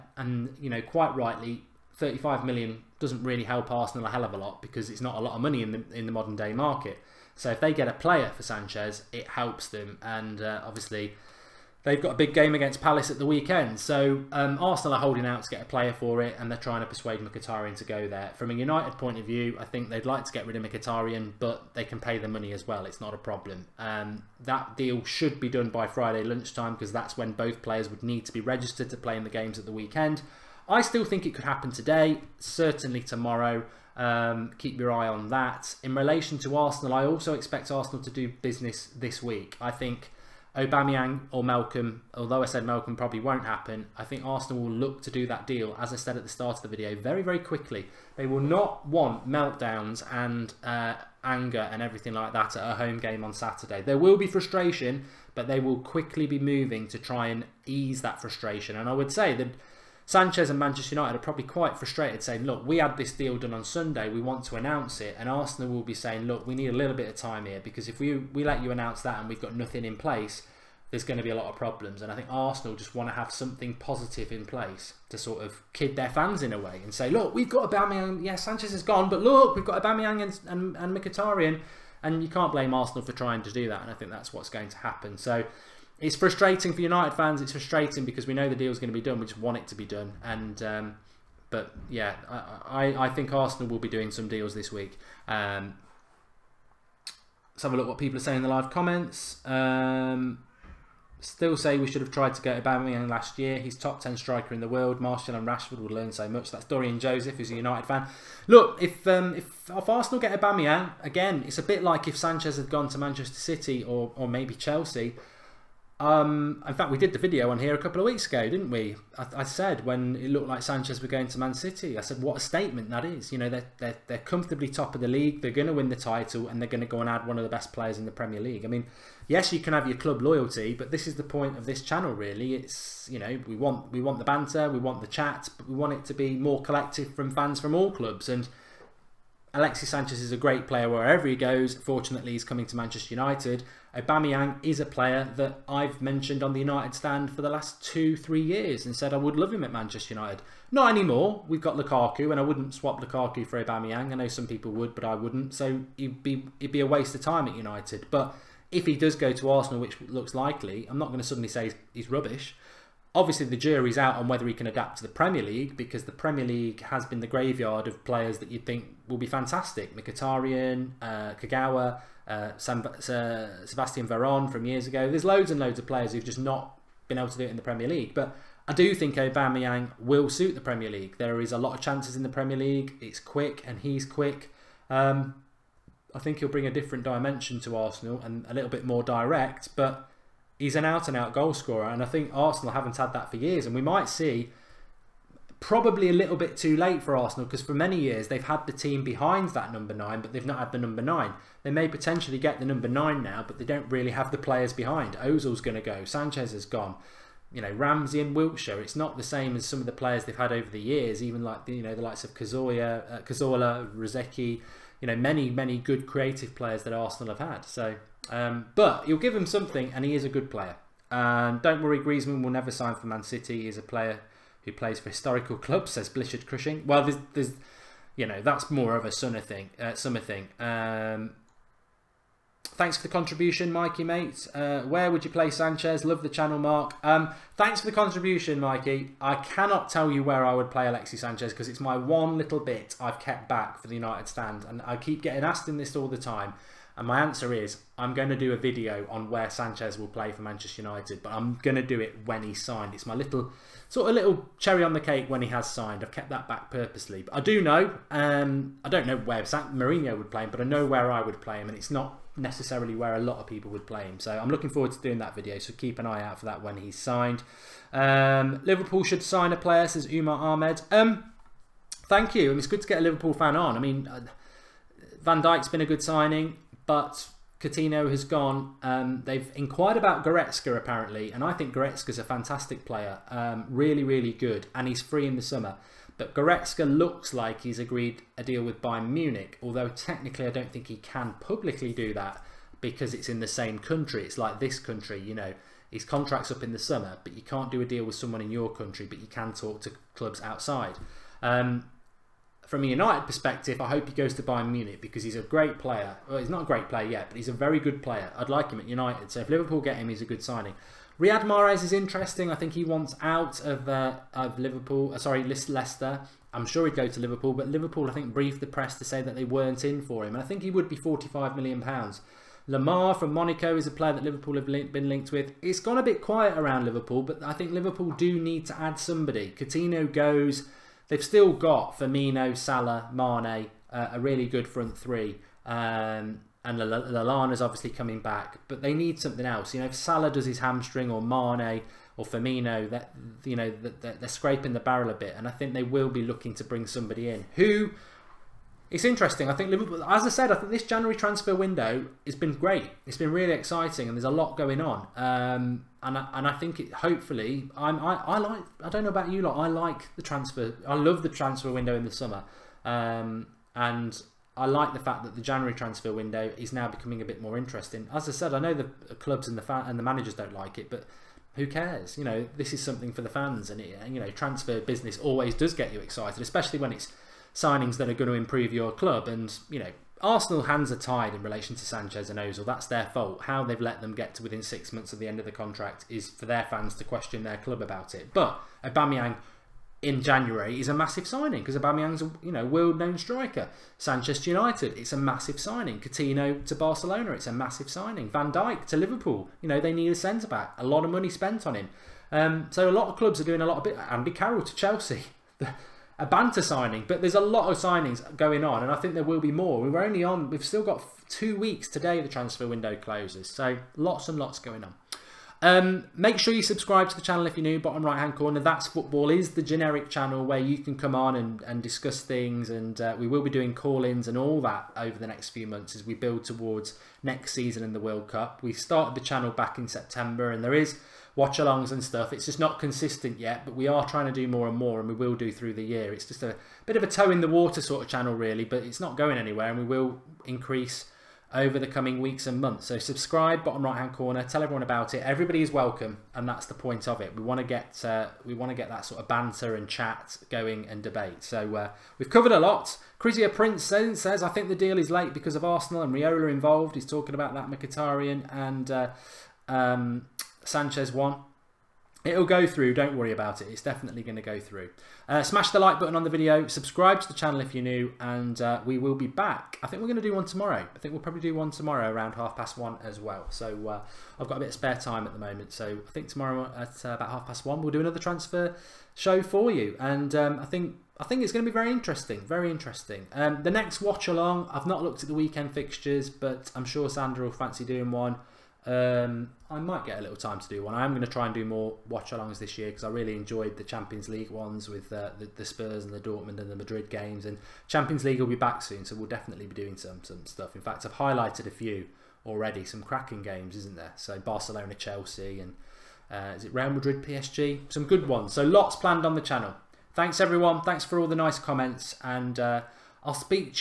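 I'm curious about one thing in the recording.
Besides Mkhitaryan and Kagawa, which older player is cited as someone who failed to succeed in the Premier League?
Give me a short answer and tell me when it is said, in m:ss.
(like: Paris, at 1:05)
Sebastian Veron, at 2:53.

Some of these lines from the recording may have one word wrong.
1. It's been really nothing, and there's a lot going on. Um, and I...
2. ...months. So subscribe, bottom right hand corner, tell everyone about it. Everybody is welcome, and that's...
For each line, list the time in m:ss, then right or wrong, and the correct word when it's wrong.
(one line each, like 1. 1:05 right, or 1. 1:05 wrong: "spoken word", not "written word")
1. 5:53 wrong: "exciting", not "nothing"
2. 7:22 right.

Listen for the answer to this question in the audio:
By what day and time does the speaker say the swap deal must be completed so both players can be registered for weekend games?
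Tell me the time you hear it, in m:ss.
0:25.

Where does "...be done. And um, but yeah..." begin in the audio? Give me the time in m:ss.
1:29.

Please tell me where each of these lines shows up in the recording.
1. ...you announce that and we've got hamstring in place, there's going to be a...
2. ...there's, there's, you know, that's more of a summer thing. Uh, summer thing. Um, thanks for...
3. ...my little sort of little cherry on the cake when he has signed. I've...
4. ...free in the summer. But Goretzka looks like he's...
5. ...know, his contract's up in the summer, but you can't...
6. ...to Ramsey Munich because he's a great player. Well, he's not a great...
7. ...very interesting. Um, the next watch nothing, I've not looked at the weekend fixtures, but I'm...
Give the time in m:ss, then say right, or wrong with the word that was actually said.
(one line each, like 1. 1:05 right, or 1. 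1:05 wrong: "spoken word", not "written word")
1. 1:08 wrong: "nothing", not "hamstring"
2. 3:47 right
3. 4:13 right
4. 4:44 right
5. 4:55 right
6. 5:04 wrong: "Bayern", not "Ramsey"
7. 8:02 wrong: "along", not "nothing".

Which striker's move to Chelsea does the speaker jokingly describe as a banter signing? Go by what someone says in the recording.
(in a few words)
Andy Carroll.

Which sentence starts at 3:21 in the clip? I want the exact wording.
They may potentially get the number nine now, but they don't really have the players behind.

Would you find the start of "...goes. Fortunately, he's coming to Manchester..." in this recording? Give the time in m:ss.
2:21.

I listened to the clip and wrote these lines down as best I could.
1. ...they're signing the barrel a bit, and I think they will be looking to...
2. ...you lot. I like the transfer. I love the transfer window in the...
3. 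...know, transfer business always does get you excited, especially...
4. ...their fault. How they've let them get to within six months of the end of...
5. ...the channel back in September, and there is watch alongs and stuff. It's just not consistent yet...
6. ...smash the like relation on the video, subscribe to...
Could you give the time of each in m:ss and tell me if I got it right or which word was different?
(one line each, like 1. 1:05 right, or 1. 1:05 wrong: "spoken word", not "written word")
1. 5:43 wrong: "scraping", not "signing"
2. 5:59 right
3. 6:14 right
4. 6:22 right
5. 7:09 right
6. 7:45 wrong: "button", not "relation".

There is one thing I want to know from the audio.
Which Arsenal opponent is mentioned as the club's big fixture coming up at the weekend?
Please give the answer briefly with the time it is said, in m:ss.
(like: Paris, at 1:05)
Palace, at 0:12.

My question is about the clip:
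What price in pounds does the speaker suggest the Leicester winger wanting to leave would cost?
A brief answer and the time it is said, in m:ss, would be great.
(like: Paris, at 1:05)
45 million pounds, at 5:20.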